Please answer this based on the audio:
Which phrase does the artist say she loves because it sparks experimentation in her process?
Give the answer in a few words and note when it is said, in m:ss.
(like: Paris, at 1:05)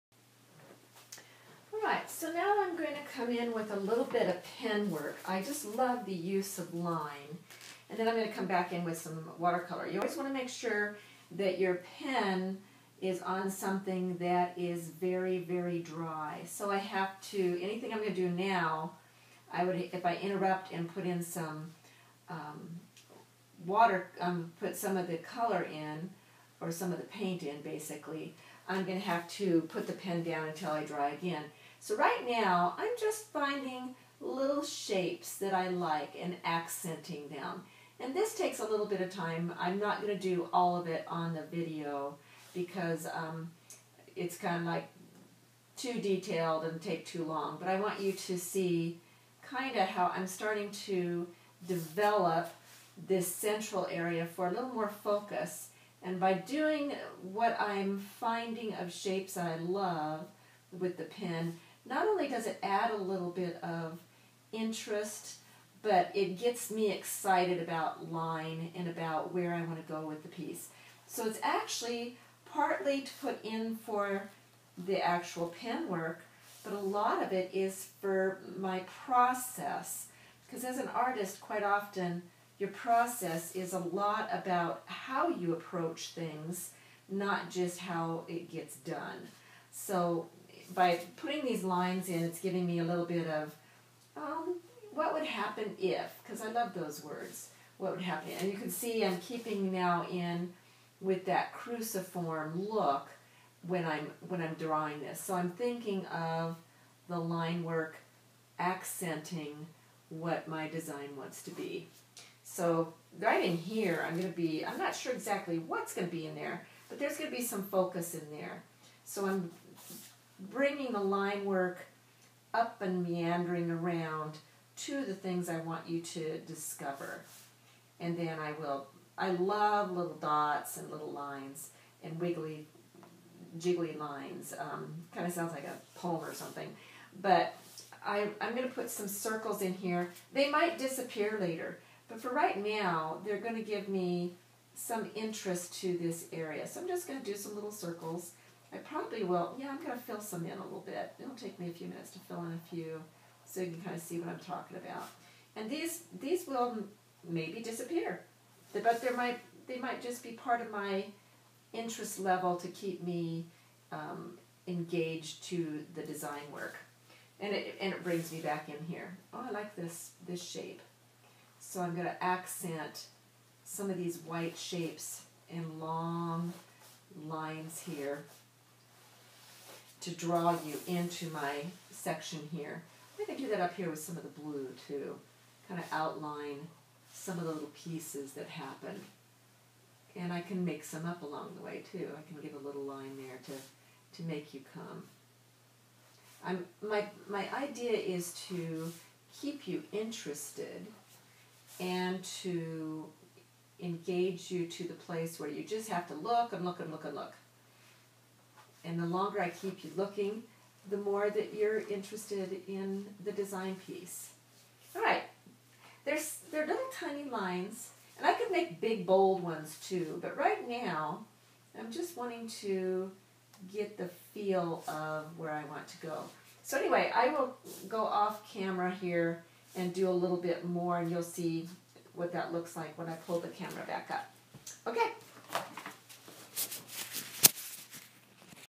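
what would happen if, at 1:34.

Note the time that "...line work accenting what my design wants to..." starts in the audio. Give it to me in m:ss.
1:47.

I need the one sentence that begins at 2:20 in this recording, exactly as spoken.
They might disappear later, but for right now, they're going to give me some interest to this area.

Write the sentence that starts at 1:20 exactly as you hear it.
Because as an artist, quite often your process is a lot about how you approach things, not just how it gets done.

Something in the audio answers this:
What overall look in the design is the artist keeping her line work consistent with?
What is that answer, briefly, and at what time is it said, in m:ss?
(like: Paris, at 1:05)
cruciform, at 1:41.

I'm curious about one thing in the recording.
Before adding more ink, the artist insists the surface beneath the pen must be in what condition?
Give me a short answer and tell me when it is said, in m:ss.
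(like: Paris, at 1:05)
very, very dry, at 0:14.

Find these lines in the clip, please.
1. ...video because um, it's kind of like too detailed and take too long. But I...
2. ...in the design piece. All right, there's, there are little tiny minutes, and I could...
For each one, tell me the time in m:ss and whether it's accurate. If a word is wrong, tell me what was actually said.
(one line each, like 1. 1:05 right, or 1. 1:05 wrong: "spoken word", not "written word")
1. 0:41 right
2. 3:32 wrong: "lines", not "minutes".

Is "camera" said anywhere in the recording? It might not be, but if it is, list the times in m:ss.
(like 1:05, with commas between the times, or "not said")
3:48, 3:53.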